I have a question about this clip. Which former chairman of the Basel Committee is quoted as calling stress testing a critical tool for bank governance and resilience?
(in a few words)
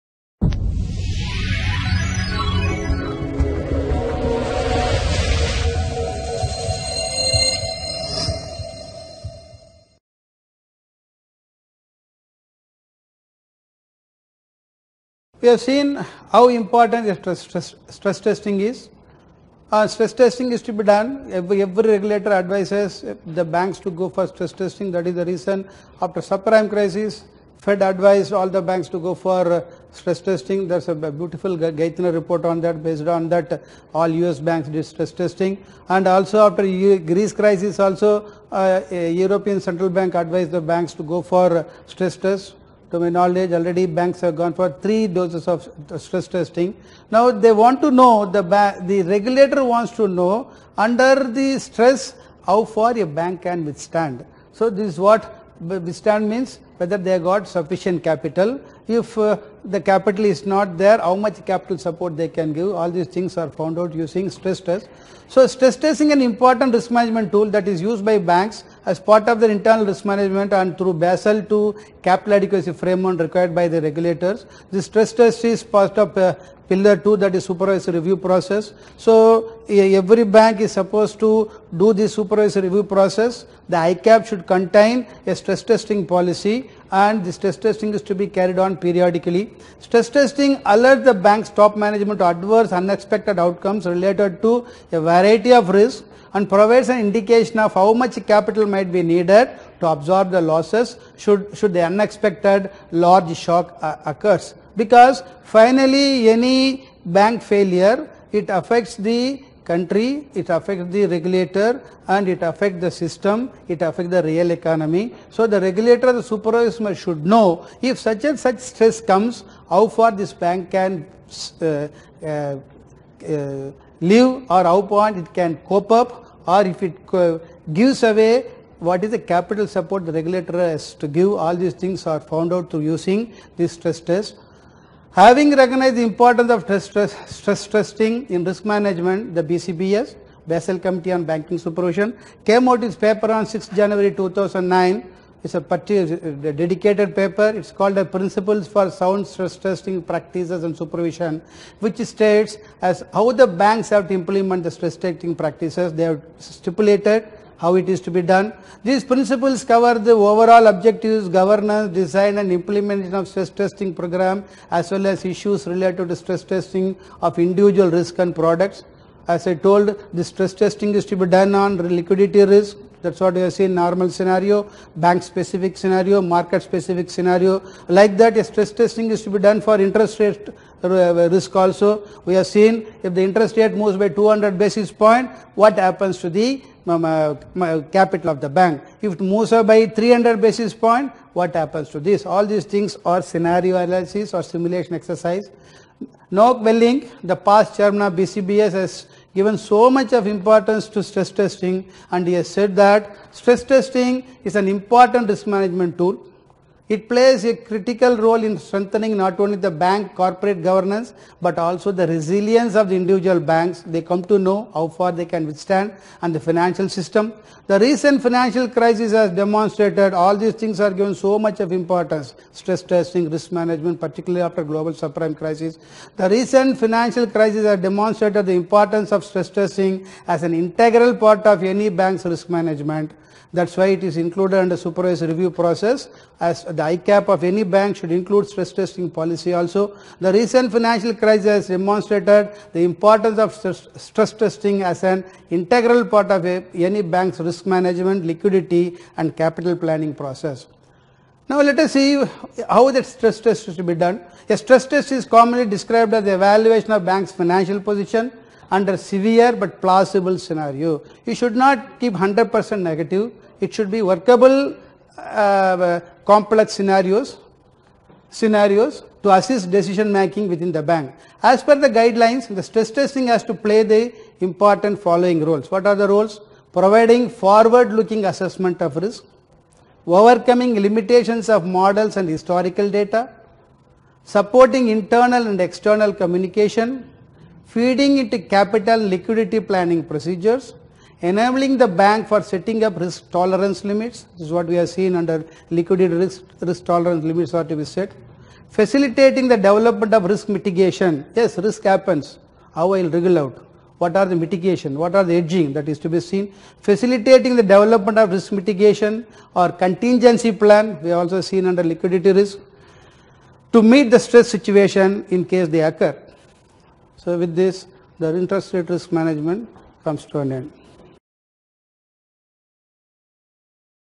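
Wellink.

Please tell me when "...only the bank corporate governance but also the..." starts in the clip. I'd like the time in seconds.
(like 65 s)
209 s.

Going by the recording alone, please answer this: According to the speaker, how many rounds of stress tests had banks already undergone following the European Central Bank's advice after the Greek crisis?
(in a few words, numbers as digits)
3.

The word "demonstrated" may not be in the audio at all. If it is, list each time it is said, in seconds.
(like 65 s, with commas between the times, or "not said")
219 s, 227 s, 241 s.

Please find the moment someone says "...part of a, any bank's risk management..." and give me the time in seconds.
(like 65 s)
246 s.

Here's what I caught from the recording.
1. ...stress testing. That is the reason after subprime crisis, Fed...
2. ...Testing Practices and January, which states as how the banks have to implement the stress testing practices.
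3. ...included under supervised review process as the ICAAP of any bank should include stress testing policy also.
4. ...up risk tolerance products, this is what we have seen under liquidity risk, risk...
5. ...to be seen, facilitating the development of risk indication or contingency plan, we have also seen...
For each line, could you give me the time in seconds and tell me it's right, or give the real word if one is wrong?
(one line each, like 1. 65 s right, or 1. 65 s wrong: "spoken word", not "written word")
1. 24 s right
2. 149 s wrong: "Supervision", not "January"
3. 234 s right
4. 292 s wrong: "limits", not "products"
5. 305 s wrong: "mitigation", not "indication".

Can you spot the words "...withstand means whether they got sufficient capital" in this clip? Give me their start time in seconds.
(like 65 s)
55 s.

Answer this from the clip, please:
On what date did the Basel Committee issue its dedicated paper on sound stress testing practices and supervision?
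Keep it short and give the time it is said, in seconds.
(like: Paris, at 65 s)
6 January 2009, at 143 s.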